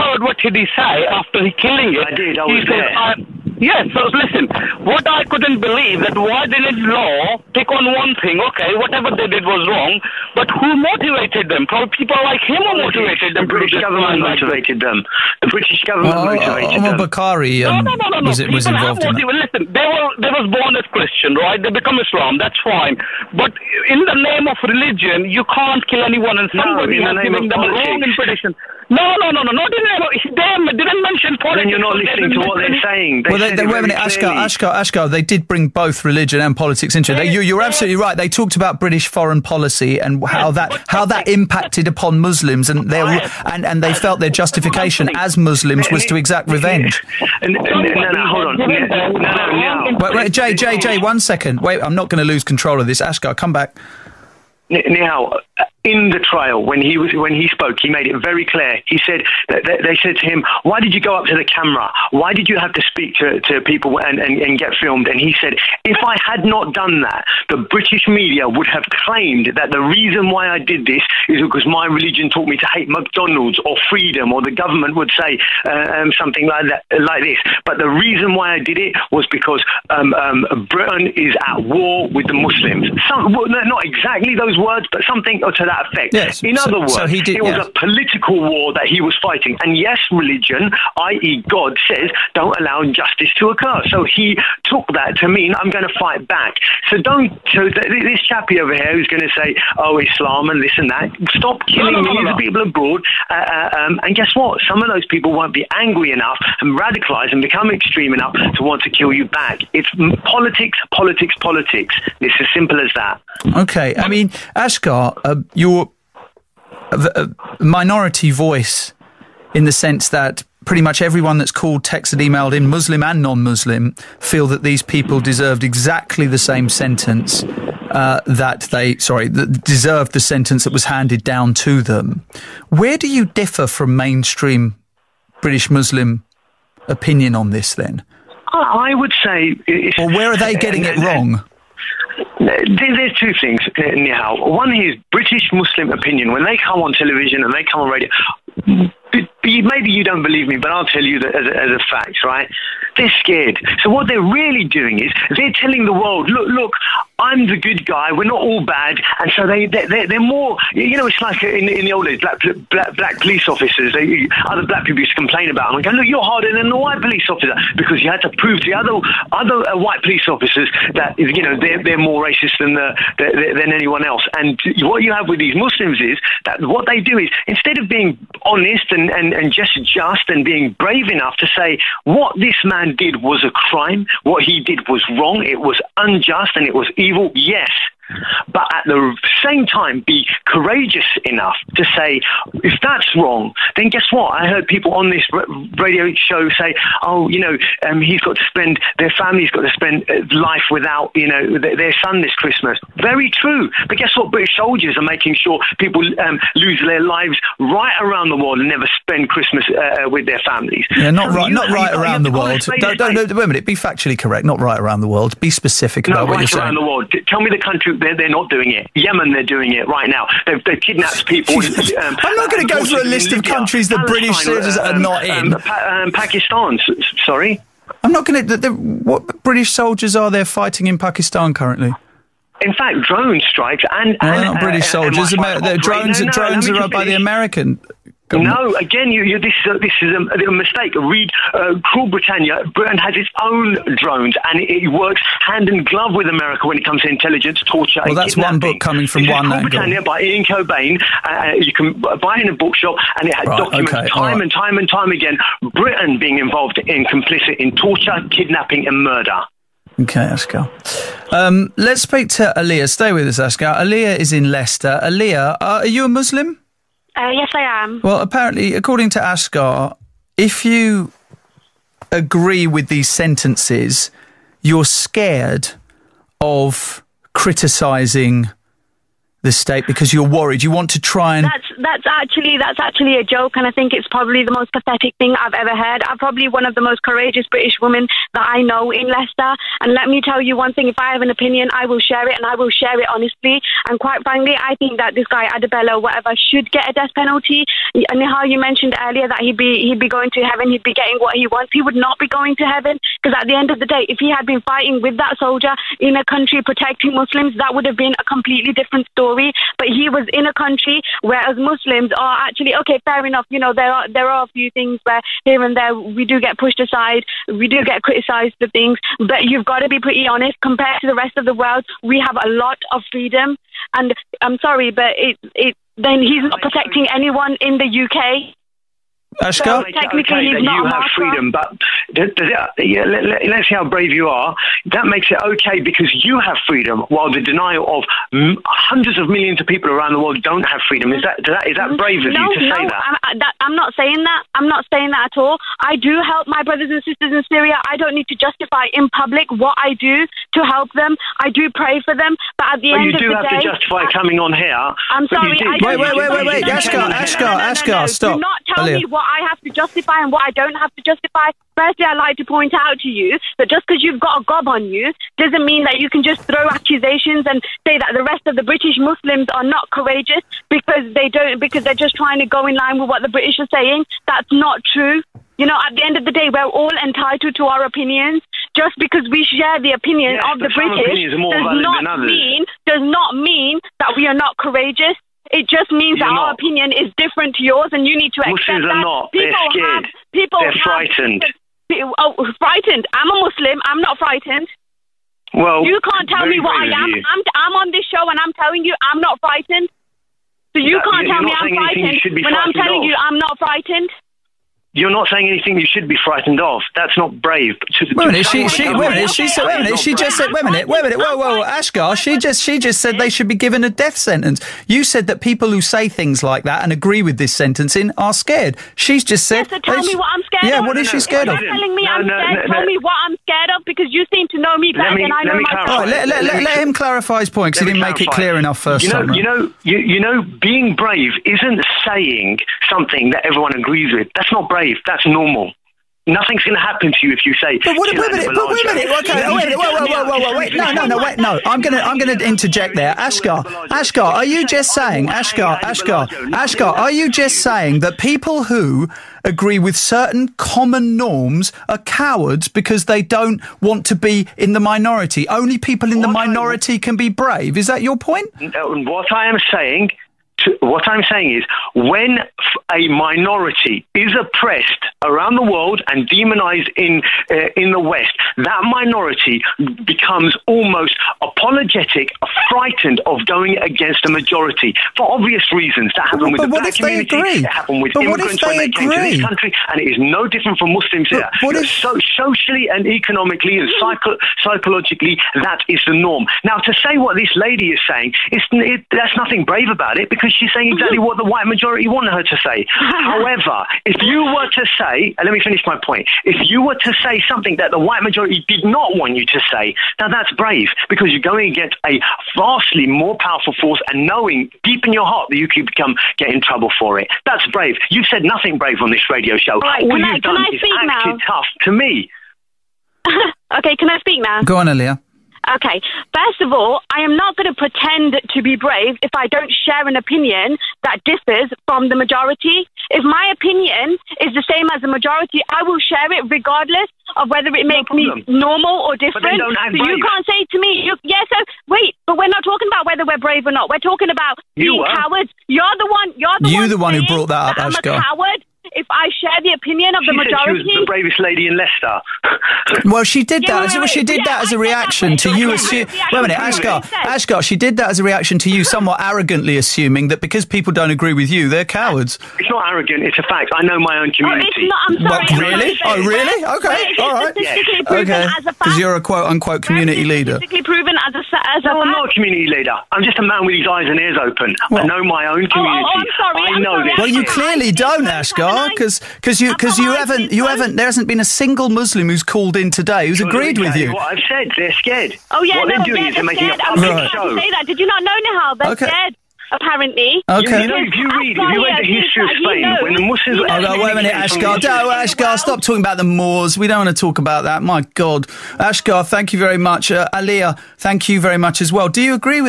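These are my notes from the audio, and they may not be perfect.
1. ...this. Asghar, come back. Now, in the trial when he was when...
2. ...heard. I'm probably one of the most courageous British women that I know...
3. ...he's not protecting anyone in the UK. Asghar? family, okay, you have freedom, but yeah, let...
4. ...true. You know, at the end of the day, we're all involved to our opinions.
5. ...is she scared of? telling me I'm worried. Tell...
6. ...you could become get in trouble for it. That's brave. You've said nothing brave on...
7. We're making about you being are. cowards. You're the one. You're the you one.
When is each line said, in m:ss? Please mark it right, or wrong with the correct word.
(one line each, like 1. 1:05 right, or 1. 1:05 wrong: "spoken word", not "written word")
1. 0:52 right
2. 4:45 right
3. 5:26 wrong: "technically", not "family"
4. 6:14 wrong: "entitled", not "involved"
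5. 7:00 wrong: "scared", not "worried"
6. 8:25 right
7. 8:53 wrong: "talking", not "making".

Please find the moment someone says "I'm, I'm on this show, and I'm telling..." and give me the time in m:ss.
6:37.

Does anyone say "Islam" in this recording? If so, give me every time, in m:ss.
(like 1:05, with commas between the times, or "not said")
0:21, 1:39.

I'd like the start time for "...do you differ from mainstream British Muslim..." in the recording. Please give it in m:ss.
2:12.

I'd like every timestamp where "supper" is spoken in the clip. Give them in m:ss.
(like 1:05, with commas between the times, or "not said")
not said.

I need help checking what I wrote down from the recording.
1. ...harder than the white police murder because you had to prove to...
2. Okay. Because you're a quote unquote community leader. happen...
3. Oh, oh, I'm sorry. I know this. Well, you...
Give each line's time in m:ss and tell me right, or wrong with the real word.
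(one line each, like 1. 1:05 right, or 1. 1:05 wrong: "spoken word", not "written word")
1. 2:46 wrong: "officer", not "murder"
2. 9:18 wrong: "proven", not "happen"
3. 9:25 right.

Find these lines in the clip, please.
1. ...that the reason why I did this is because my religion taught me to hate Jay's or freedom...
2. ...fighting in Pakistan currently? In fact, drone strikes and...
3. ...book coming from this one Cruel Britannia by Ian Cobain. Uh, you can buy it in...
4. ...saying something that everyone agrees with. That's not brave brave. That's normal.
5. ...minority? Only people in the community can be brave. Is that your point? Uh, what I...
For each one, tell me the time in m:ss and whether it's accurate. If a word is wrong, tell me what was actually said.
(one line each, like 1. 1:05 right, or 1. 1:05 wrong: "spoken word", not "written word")
1. 1:09 wrong: "McDonald", not "Jay"
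2. 3:50 right
3. 4:08 right
4. 7:12 right
5. 7:34 wrong: "minority", not "community".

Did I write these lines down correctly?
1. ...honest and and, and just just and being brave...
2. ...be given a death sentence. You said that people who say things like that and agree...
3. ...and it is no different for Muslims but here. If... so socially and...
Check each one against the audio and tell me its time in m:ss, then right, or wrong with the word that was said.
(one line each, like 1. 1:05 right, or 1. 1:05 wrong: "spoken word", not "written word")
1. 2:58 right
2. 6:53 right
3. 7:59 right.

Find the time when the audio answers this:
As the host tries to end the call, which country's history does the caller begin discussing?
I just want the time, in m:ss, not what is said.
9:42.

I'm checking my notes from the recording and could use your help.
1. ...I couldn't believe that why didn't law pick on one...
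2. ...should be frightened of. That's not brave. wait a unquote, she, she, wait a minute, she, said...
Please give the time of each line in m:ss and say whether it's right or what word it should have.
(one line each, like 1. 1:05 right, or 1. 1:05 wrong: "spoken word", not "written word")
1. 0:05 right
2. 6:45 wrong: "minute", not "unquote".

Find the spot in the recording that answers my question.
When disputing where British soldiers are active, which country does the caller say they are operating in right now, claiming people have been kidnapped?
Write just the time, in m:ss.
3:38.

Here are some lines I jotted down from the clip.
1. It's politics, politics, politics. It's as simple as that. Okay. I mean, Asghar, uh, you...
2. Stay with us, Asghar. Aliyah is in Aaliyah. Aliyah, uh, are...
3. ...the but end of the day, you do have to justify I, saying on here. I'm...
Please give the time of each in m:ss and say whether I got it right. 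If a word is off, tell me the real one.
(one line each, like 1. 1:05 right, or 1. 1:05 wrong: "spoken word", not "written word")
1. 1:49 right
2. 4:22 wrong: "Leicester", not "Aaliyah"
3. 5:52 wrong: "coming", not "saying".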